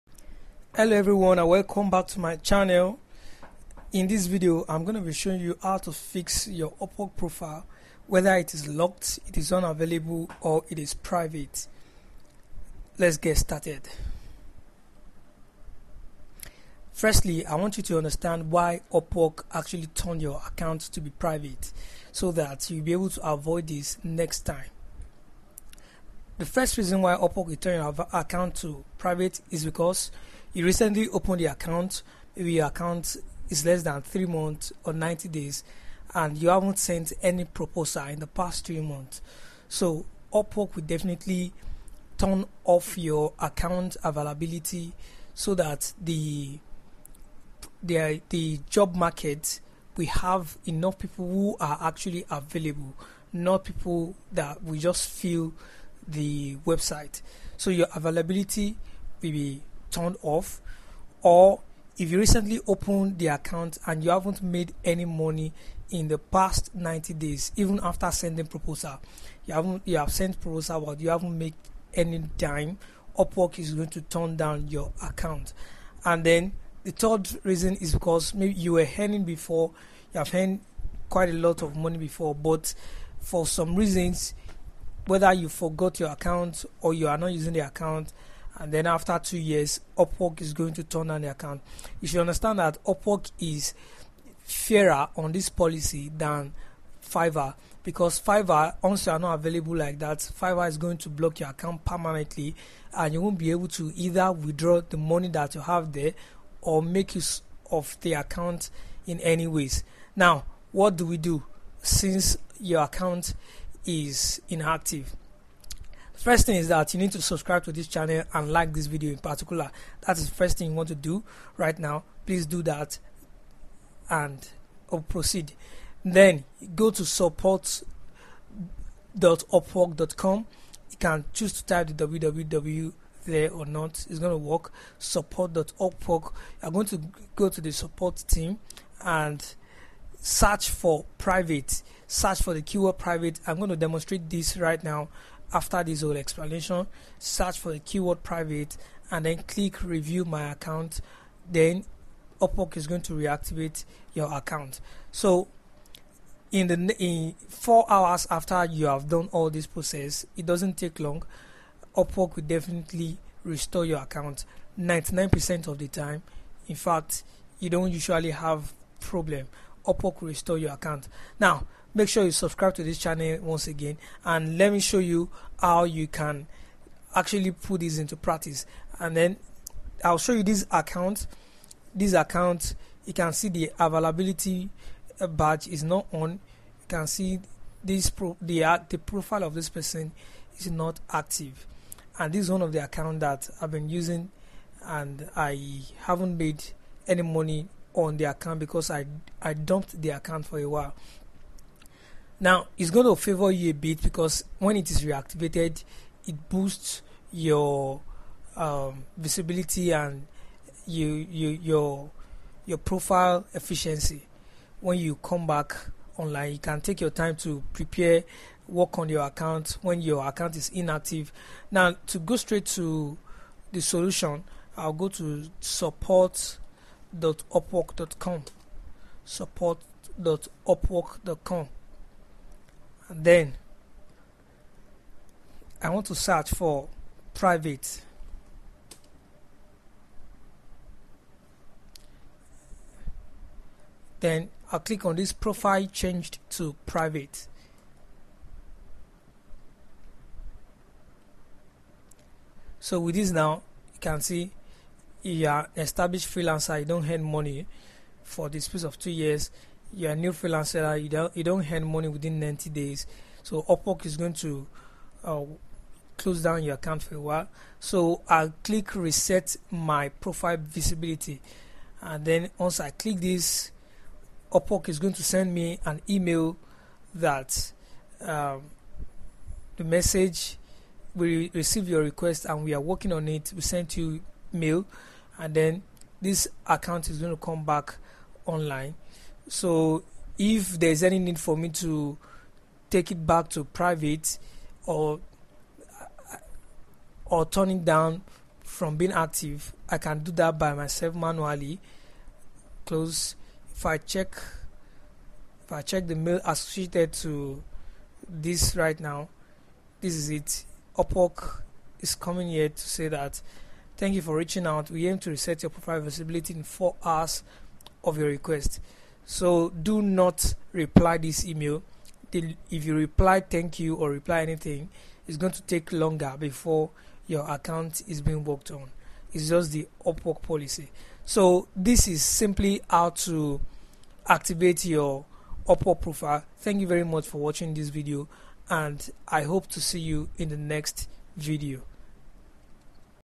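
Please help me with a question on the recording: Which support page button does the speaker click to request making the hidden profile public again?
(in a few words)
reset my profile visibility.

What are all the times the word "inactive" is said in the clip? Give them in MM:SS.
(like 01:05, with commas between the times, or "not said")
01:54, 03:40.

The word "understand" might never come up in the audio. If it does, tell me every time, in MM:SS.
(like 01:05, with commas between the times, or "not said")
00:17, 01:32.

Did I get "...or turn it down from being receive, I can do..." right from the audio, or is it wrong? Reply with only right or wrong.
wrong.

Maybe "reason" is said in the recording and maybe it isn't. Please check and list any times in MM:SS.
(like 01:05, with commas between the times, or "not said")
00:26, 01:17, 01:23.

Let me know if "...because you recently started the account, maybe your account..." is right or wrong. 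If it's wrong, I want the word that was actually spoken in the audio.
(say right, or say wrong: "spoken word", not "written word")
wrong: "opened", not "started".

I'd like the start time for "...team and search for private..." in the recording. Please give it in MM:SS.
02:18.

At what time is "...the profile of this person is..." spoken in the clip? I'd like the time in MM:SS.
03:08.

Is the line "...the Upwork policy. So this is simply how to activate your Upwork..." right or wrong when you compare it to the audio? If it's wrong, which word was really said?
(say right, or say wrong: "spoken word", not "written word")
right.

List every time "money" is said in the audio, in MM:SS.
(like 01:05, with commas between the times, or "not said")
01:05, 01:21, 01:44, 03:17, 04:17, 04:21.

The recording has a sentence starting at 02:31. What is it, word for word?
Then Upwork is going to reactivate your account.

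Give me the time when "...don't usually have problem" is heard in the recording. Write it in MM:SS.
02:47.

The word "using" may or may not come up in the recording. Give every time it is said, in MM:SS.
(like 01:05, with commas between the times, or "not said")
01:27, 03:13.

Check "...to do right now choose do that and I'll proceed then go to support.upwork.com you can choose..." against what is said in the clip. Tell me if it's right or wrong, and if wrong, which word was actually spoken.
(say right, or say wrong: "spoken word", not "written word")
wrong: "please", not "choose".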